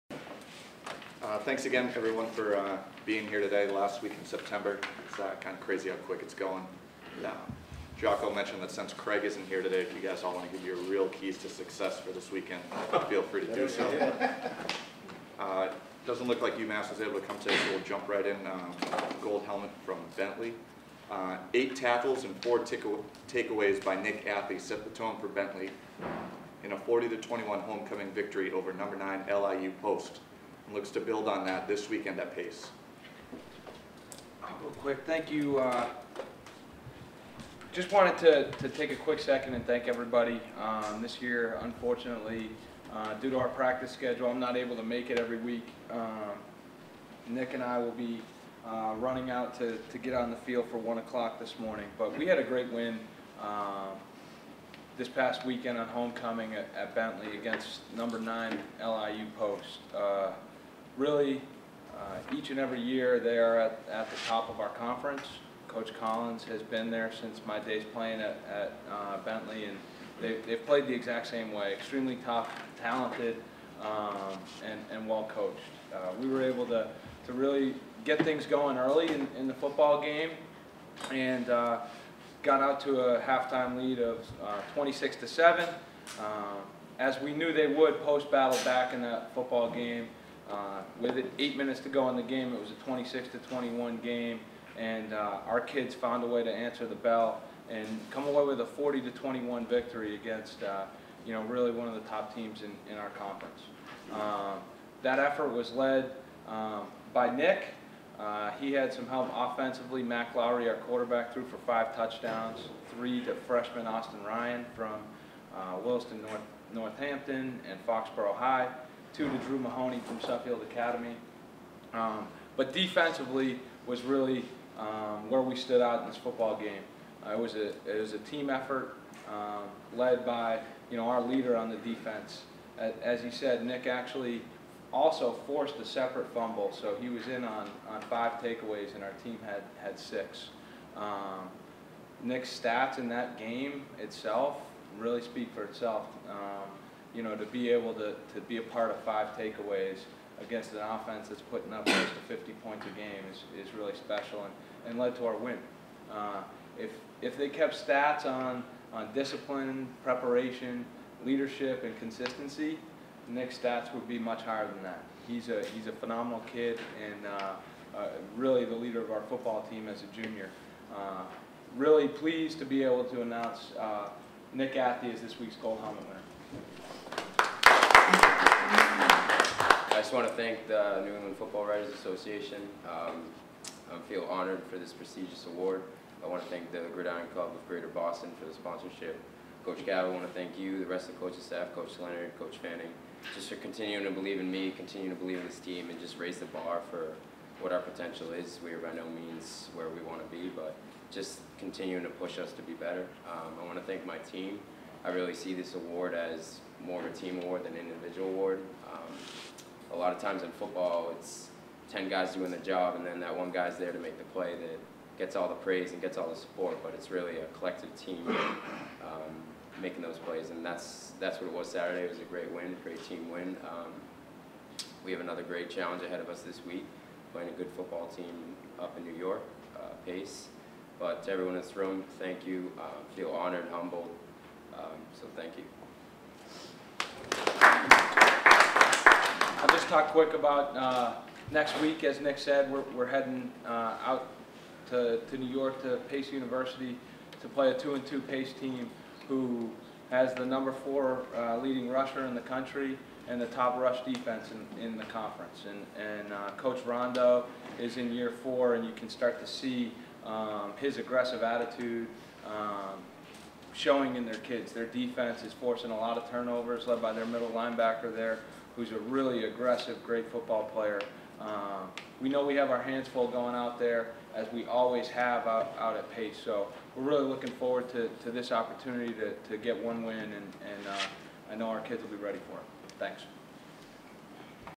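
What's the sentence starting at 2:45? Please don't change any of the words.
He's a, he's a phenomenal kid and uh, uh, really the leader of our football team as a junior.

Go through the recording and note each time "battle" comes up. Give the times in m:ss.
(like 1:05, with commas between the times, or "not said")
1:28.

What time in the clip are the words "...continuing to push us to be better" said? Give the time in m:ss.
3:21.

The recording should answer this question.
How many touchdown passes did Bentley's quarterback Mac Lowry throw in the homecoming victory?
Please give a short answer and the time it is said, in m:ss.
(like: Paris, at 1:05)
5, at 1:51.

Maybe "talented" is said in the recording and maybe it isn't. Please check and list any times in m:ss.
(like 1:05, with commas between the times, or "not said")
1:12.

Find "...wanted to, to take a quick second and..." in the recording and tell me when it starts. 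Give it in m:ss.
0:37.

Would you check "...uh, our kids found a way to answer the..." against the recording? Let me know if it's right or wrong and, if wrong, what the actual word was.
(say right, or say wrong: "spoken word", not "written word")
right.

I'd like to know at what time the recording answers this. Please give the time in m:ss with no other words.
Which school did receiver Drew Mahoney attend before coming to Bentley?
2:00.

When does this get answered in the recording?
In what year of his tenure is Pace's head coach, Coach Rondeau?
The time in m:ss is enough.
4:18.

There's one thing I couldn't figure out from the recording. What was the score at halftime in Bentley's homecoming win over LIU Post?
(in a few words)
26-7.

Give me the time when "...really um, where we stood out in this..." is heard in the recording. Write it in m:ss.
2:04.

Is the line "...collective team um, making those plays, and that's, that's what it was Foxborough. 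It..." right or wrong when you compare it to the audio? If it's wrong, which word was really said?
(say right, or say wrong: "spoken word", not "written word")
wrong: "Saturday", not "Foxborough".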